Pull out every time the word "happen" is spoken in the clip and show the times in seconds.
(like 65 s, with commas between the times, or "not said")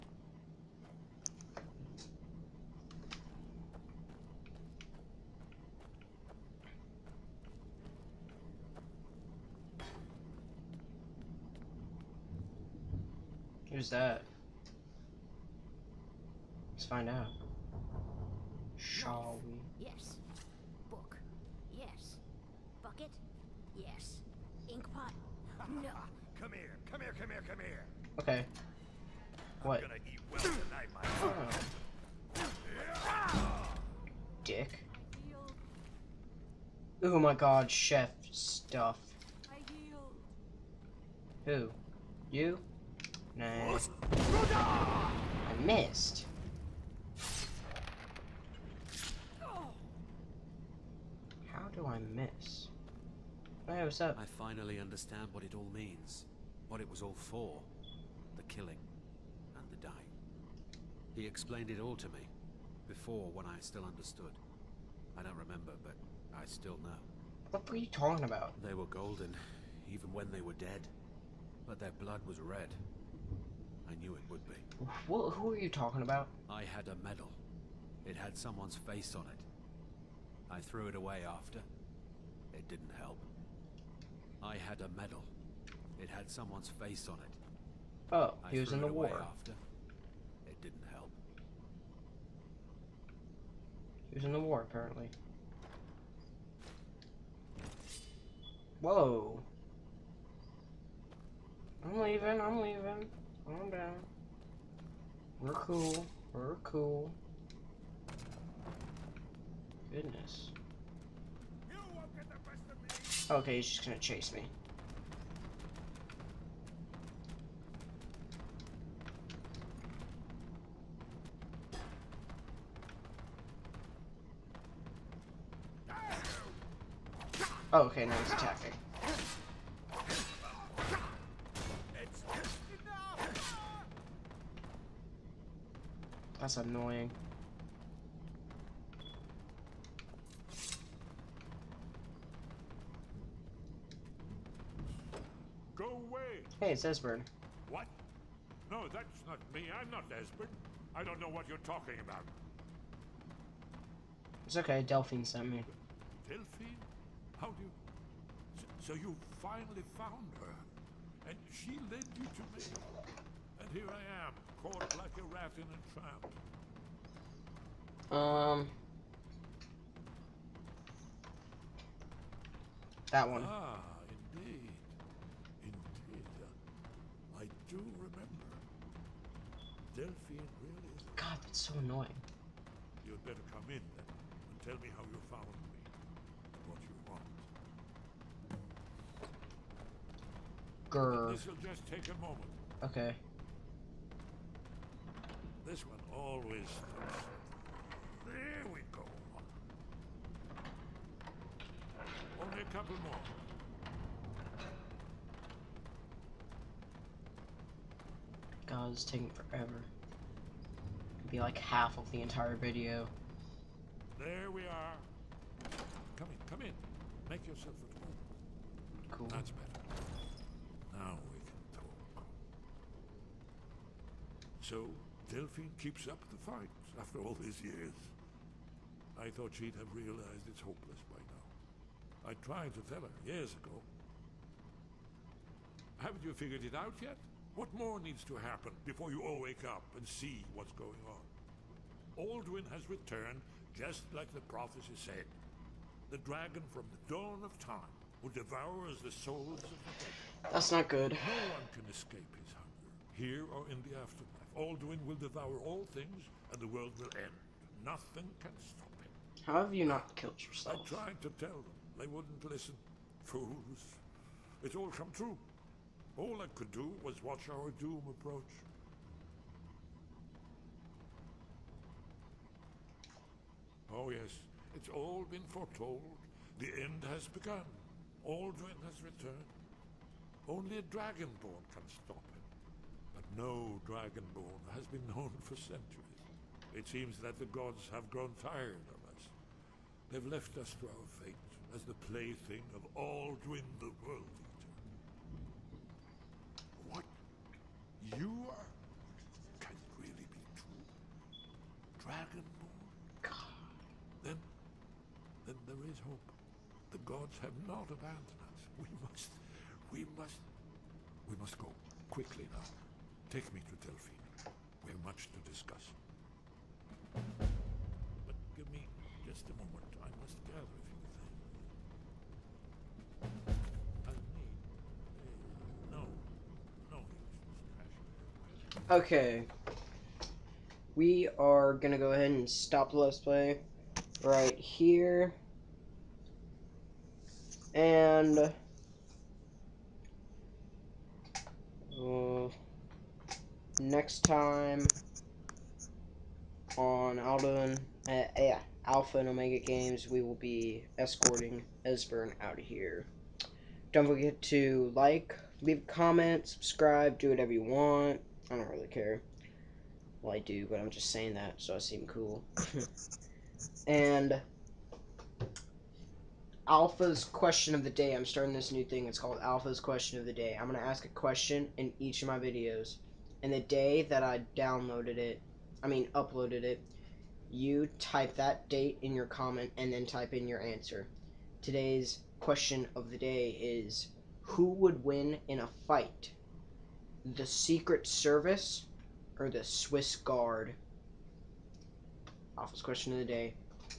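238 s.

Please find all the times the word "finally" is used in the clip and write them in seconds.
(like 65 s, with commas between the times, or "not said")
54 s, 159 s.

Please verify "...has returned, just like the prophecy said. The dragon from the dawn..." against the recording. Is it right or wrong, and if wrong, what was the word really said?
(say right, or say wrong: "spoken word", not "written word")
right.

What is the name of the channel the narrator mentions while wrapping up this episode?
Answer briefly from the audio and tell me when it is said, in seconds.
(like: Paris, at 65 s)
Alpha and Omega Games, at 348 s.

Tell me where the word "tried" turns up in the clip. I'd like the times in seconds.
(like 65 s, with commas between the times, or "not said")
232 s, 261 s.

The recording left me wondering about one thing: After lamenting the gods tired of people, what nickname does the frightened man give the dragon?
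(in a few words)
World Eater.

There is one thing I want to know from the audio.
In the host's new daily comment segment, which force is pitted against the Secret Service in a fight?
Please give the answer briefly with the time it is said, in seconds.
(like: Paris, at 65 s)
Swiss Guard, at 389 s.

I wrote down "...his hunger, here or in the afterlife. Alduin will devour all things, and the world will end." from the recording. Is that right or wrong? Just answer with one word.
right.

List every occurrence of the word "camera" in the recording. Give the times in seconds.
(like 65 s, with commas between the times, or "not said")
not said.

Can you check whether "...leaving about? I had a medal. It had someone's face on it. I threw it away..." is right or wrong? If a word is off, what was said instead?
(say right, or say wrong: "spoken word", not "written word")
wrong: "talking", not "leaving".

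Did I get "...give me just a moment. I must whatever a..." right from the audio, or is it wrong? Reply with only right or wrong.
wrong.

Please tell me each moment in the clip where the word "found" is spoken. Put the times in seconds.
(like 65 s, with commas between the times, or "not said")
159 s, 185 s.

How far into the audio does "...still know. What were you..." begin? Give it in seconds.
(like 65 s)
66 s.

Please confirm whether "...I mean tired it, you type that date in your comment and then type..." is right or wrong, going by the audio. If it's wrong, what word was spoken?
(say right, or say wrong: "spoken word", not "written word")
wrong: "uploaded", not "tired".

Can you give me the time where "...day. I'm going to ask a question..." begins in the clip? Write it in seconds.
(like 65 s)
370 s.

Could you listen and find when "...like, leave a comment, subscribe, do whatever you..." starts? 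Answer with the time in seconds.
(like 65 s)
354 s.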